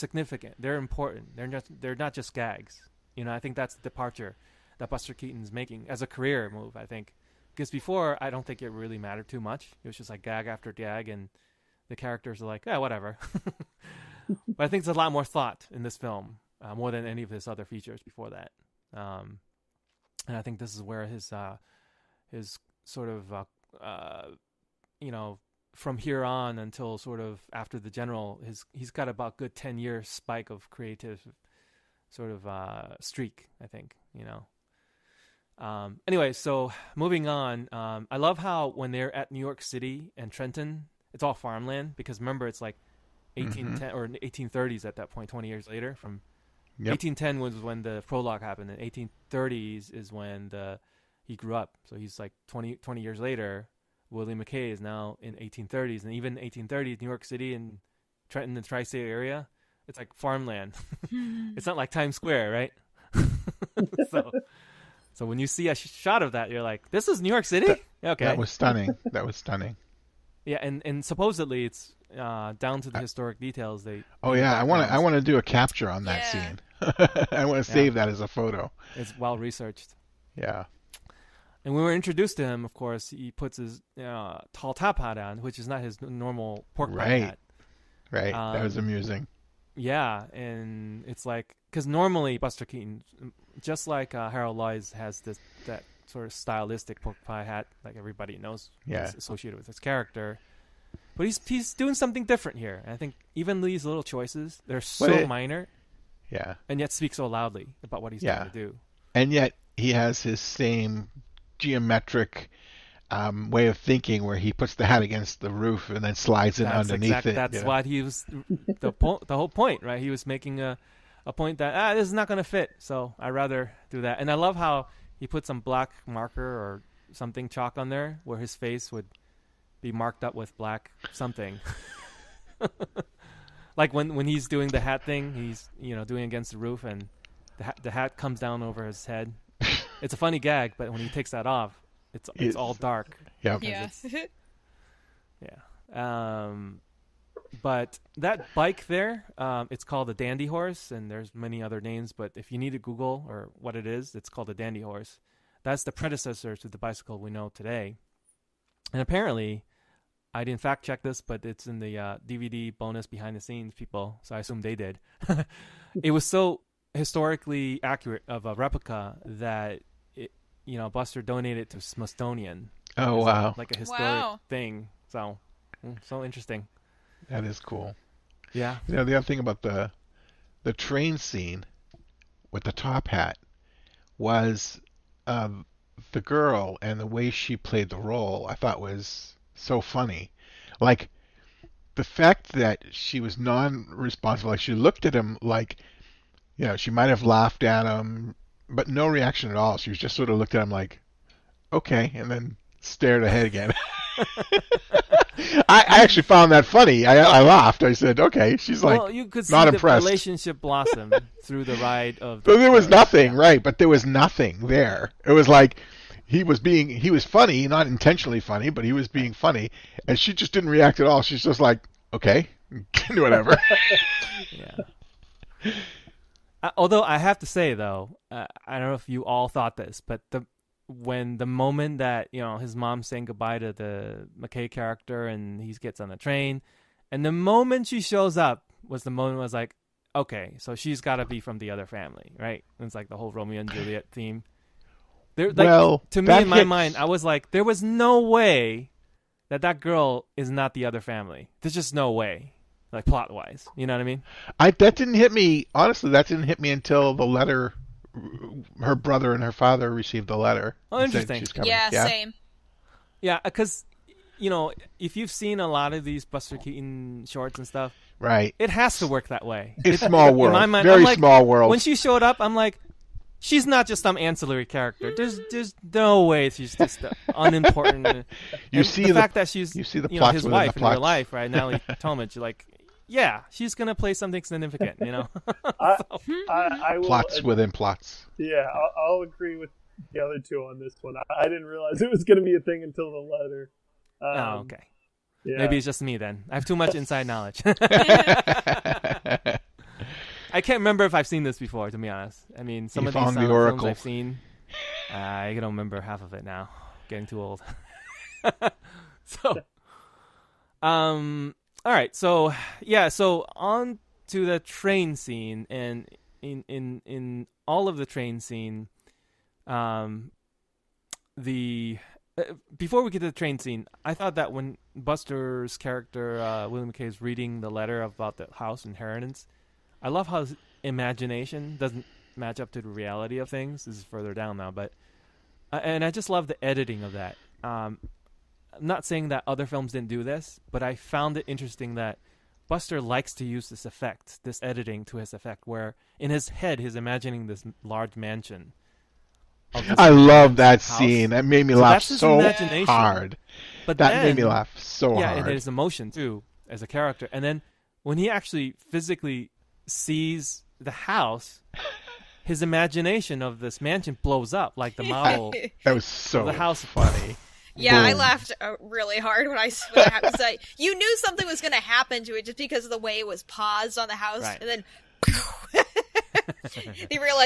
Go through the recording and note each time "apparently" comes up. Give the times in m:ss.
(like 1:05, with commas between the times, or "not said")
2:39.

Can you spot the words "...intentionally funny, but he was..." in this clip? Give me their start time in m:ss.
3:37.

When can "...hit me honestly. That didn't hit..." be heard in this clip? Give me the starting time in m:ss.
4:15.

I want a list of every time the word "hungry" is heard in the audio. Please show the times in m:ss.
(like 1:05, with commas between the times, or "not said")
not said.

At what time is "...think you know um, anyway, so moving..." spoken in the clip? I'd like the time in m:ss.
0:33.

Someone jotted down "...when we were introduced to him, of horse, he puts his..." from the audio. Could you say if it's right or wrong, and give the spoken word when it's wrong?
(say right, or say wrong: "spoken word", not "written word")
wrong: "course", not "horse".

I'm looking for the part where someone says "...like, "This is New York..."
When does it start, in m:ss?
1:06.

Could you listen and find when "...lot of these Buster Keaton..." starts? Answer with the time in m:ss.
4:25.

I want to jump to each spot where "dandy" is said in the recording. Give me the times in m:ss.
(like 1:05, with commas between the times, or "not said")
2:30, 2:34.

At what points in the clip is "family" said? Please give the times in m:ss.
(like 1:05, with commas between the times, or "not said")
4:01, 4:11.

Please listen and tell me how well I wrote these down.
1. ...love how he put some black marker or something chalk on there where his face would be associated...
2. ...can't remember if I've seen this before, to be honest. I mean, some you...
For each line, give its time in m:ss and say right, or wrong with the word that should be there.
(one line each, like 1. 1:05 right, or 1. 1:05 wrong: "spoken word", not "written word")
1. 2:04 wrong: "marked", not "associated"
2. 5:00 right.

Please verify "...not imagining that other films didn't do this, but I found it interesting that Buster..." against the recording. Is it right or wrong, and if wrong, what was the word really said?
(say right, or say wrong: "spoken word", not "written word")
wrong: "saying", not "imagining".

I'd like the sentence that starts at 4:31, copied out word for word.
When she showed up, I'm like, she's not just some ancillary character.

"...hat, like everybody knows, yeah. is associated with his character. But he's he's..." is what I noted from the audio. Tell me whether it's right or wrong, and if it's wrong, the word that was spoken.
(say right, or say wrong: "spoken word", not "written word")
right.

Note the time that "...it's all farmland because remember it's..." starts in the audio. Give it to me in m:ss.
0:41.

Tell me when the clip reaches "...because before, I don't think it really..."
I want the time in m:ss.
0:07.